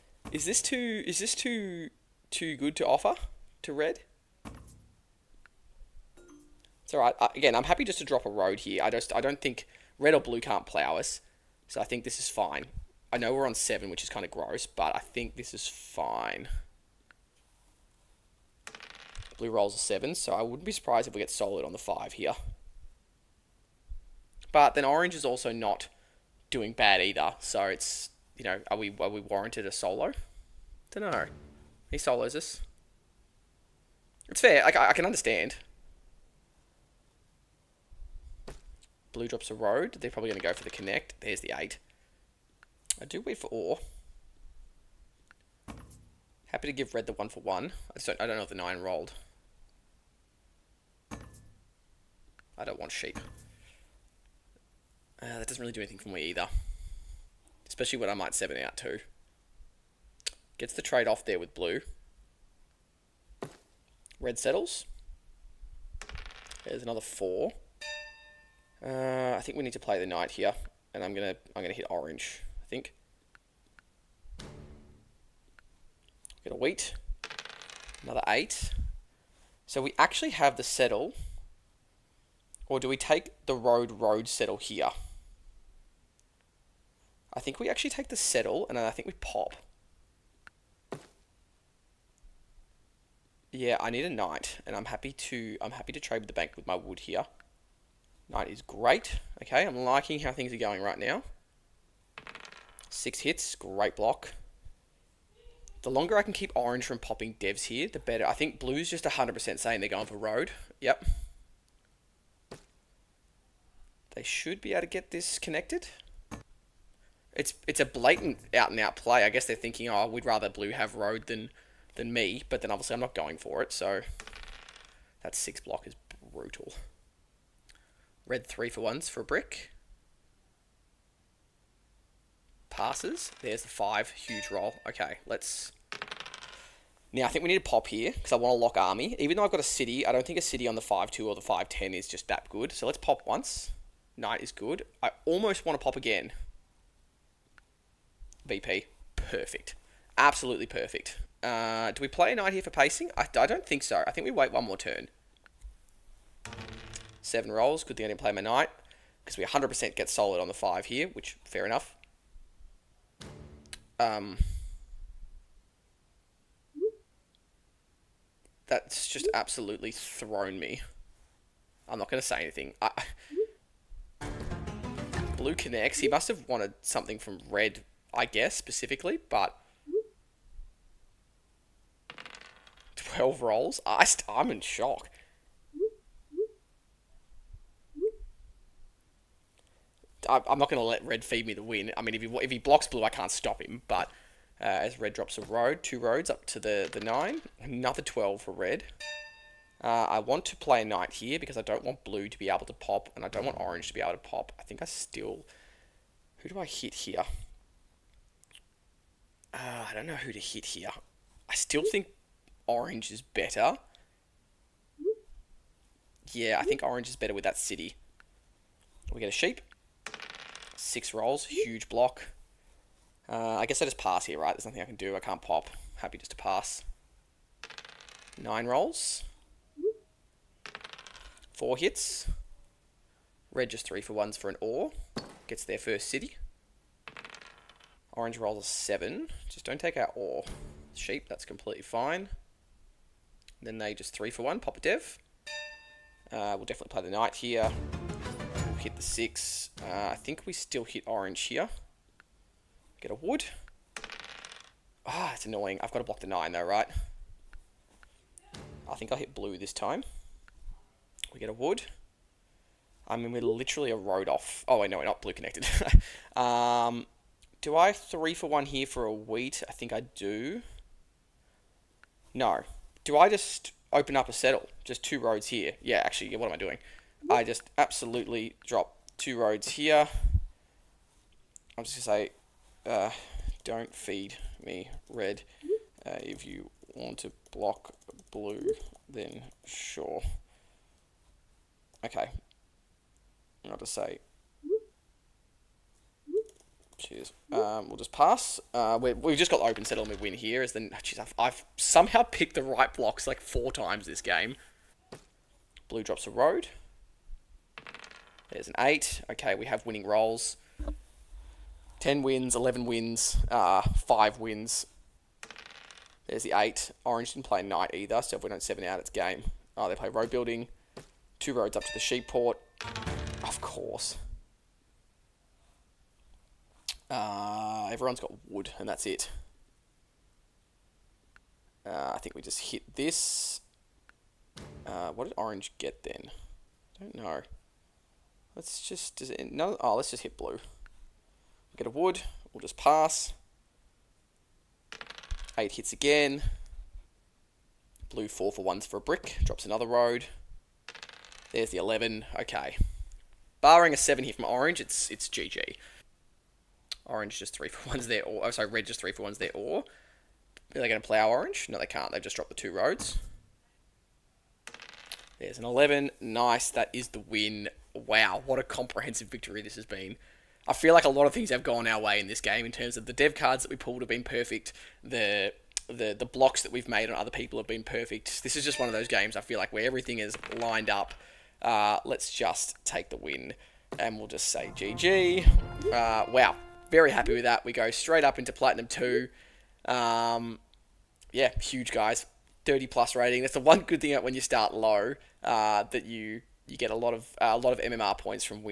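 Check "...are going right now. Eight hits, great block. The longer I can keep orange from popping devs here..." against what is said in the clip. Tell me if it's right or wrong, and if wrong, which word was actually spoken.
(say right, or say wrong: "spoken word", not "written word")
wrong: "Six", not "Eight".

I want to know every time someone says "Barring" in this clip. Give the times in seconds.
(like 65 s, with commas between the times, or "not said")
353 s.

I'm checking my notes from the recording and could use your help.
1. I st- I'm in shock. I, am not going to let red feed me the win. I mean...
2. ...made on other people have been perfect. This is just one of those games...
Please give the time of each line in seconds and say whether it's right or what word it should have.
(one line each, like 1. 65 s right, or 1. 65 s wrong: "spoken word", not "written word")
1. 183 s right
2. 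376 s right.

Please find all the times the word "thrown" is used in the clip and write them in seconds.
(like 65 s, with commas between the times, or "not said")
169 s.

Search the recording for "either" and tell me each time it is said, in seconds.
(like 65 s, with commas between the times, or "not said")
27 s, 56 s, 317 s.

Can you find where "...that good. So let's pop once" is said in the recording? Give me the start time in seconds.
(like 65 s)
142 s.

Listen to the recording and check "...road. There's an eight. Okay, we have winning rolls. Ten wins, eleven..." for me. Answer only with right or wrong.
right.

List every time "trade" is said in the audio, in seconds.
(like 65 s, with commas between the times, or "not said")
60 s, 95 s.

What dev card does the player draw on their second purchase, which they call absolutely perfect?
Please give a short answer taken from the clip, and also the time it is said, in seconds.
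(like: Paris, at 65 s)
VP, at 148 s.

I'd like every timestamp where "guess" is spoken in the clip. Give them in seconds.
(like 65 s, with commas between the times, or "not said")
119 s, 178 s, 223 s.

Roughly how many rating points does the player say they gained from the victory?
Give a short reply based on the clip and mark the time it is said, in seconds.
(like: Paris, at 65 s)
30 plus, at 392 s.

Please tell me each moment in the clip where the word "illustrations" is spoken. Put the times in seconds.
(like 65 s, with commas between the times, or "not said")
not said.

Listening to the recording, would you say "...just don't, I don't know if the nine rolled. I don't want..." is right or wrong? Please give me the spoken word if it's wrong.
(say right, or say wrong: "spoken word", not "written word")
right.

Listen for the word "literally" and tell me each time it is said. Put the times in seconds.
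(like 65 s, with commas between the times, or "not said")
263 s.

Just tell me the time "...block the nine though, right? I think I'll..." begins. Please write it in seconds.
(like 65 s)
256 s.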